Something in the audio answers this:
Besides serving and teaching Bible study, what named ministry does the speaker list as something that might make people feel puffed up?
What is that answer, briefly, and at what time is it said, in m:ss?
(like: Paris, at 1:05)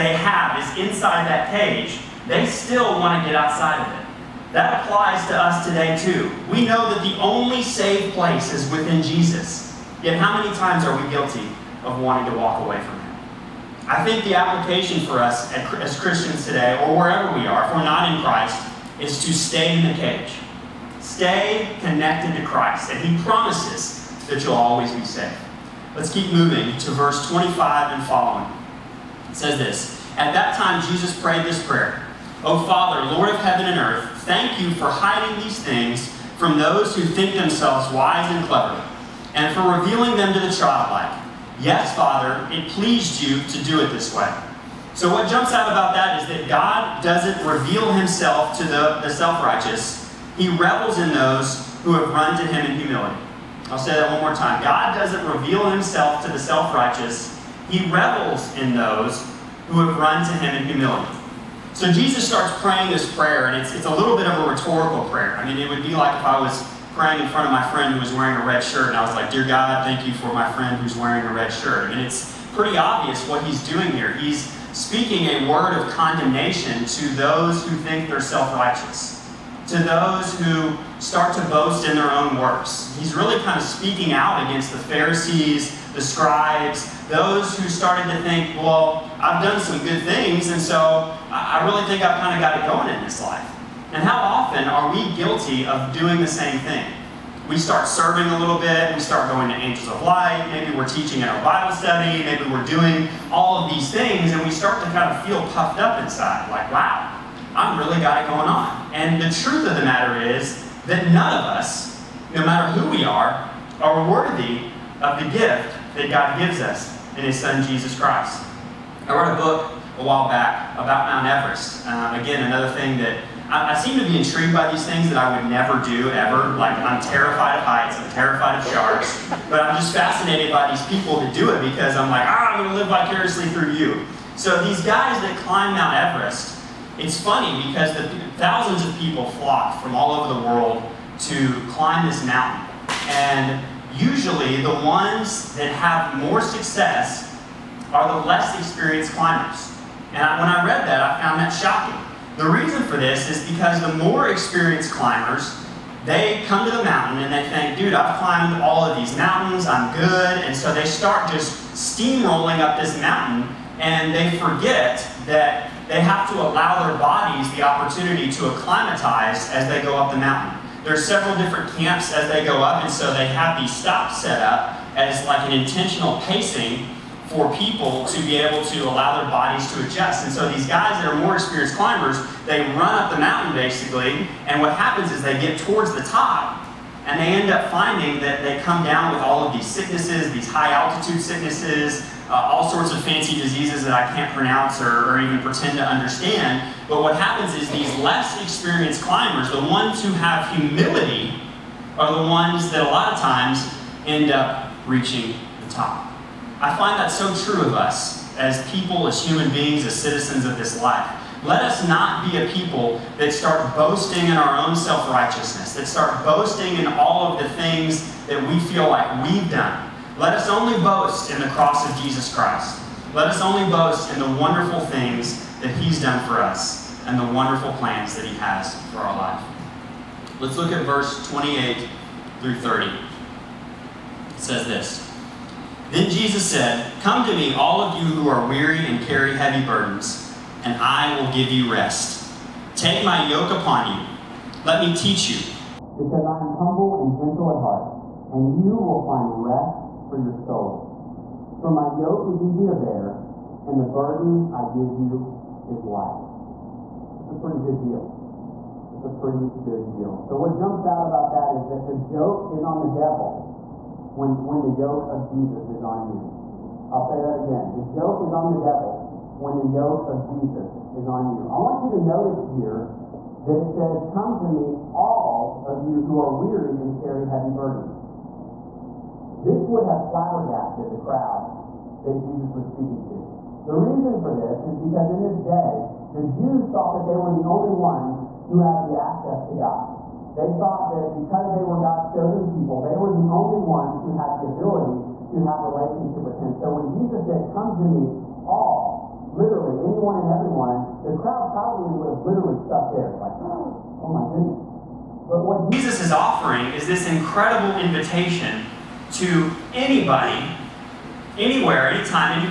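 Angels of Light, at 1:39.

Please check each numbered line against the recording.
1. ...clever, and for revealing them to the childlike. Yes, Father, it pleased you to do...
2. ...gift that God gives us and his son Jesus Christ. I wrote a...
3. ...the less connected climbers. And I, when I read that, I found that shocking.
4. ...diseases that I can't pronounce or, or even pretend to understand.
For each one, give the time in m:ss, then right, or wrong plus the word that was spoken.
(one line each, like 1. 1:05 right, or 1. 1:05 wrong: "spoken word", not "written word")
1. 0:38 right
2. 1:55 right
3. 2:28 wrong: "experienced", not "connected"
4. 3:13 right.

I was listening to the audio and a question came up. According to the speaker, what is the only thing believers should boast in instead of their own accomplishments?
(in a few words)
The cross of Jesus Christ.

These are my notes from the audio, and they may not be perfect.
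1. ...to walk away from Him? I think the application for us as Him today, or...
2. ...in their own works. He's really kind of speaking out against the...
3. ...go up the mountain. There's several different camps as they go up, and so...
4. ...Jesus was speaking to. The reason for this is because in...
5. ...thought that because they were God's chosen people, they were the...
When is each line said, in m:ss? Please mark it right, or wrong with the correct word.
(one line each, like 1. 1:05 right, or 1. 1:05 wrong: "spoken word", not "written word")
1. 0:12 wrong: "Christians", not "Him"
2. 1:21 right
3. 2:49 right
4. 4:42 right
5. 4:50 right.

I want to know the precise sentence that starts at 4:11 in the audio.
For my yoke is easy to bear, and the burden I give you is light.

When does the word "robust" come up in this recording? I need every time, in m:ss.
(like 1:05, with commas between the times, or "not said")
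not said.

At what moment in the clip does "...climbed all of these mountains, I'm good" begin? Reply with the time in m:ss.
2:38.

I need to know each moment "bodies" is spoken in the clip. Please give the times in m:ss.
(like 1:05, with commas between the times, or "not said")
2:46, 2:59.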